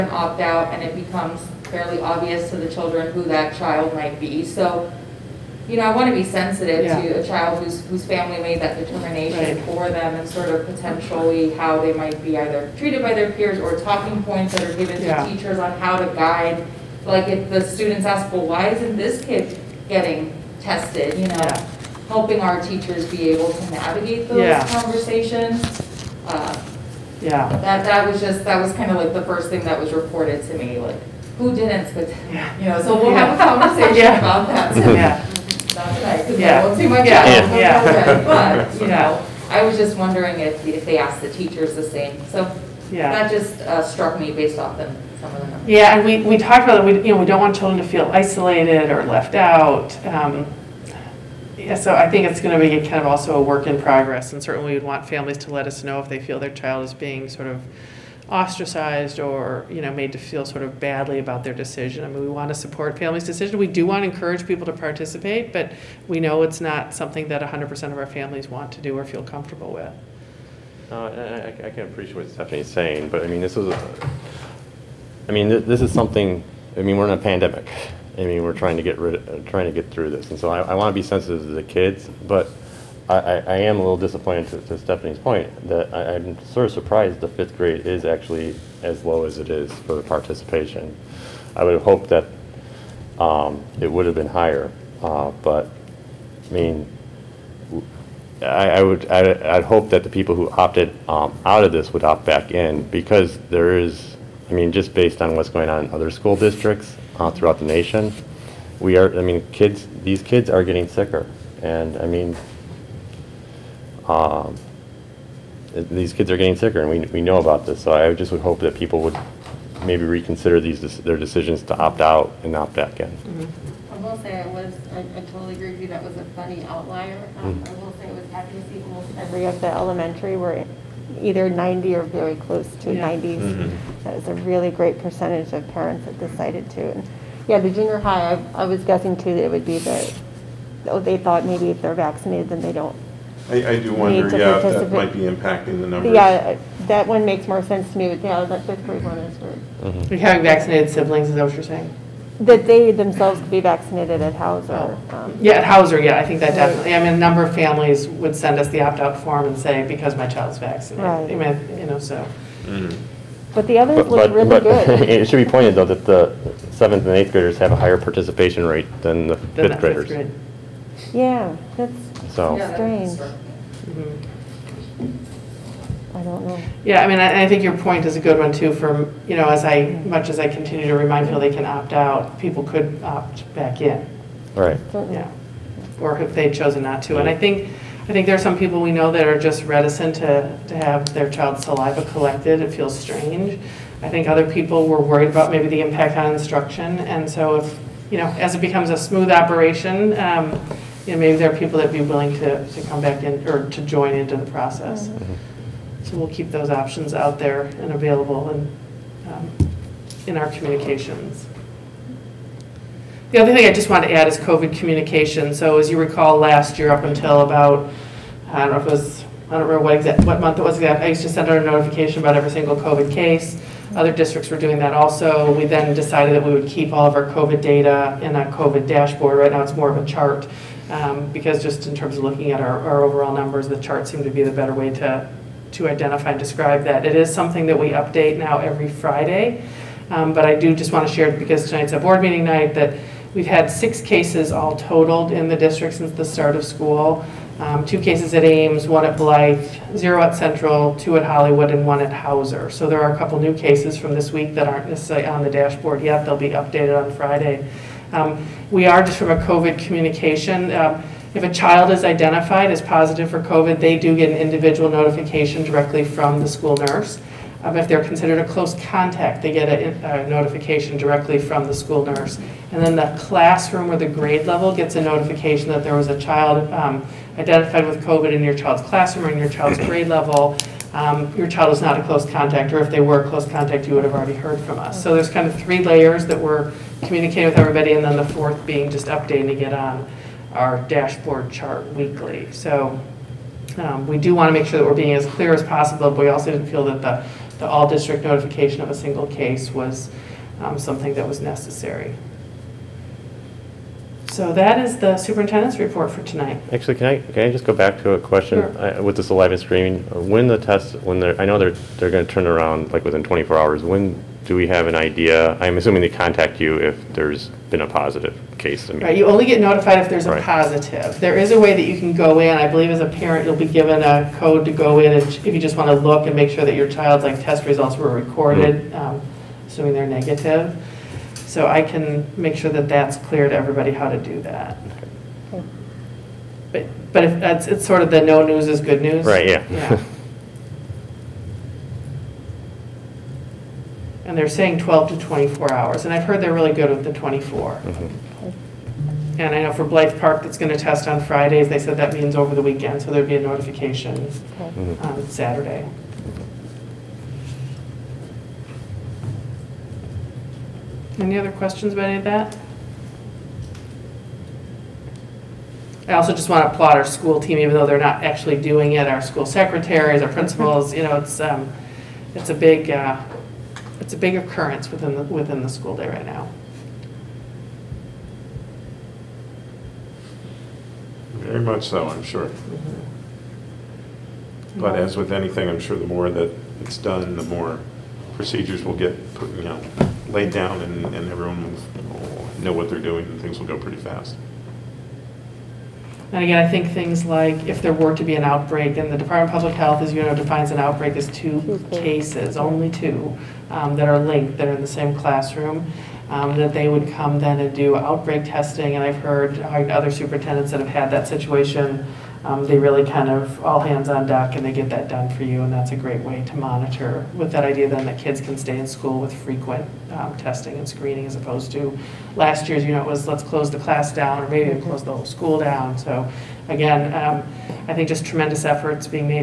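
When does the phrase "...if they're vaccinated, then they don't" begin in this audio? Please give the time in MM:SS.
02:21.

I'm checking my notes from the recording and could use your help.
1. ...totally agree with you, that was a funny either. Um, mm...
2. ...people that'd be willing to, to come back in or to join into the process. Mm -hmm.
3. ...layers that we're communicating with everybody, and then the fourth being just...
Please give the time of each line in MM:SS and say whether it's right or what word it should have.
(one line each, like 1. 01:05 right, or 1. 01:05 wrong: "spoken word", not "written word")
1. 02:05 wrong: "outlier", not "either"
2. 03:21 right
3. 04:45 right.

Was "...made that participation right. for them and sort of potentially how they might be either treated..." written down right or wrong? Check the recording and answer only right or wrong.
wrong.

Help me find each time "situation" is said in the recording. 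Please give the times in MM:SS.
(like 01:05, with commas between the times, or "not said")
06:51.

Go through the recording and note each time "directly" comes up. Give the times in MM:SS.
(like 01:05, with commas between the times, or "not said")
04:25, 04:30.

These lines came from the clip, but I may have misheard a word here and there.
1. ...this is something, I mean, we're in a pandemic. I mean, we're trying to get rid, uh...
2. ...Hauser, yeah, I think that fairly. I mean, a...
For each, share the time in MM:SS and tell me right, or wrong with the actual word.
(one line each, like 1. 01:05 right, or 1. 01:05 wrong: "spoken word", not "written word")
1. 01:15 right
2. 02:35 wrong: "definitely", not "fairly".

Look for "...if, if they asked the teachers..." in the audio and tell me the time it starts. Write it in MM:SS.
00:40.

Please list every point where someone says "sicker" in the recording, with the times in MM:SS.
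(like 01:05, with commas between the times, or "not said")
01:50, 01:56.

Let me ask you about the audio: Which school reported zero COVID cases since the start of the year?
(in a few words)
Central.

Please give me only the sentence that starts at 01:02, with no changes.
I mean, we want to support families' decision.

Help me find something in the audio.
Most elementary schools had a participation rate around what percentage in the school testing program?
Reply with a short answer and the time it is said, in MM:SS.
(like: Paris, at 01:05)
90, at 02:11.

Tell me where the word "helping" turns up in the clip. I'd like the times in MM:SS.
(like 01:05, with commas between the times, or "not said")
00:22.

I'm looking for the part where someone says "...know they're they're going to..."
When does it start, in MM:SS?
05:11.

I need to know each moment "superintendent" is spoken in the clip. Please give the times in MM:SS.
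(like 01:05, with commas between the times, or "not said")
05:05, 06:50.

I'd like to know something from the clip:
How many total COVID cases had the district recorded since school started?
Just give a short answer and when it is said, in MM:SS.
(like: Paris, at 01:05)
6, at 04:03.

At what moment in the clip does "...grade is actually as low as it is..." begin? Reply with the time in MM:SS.
01:27.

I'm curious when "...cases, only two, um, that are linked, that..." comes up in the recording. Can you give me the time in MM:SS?
06:42.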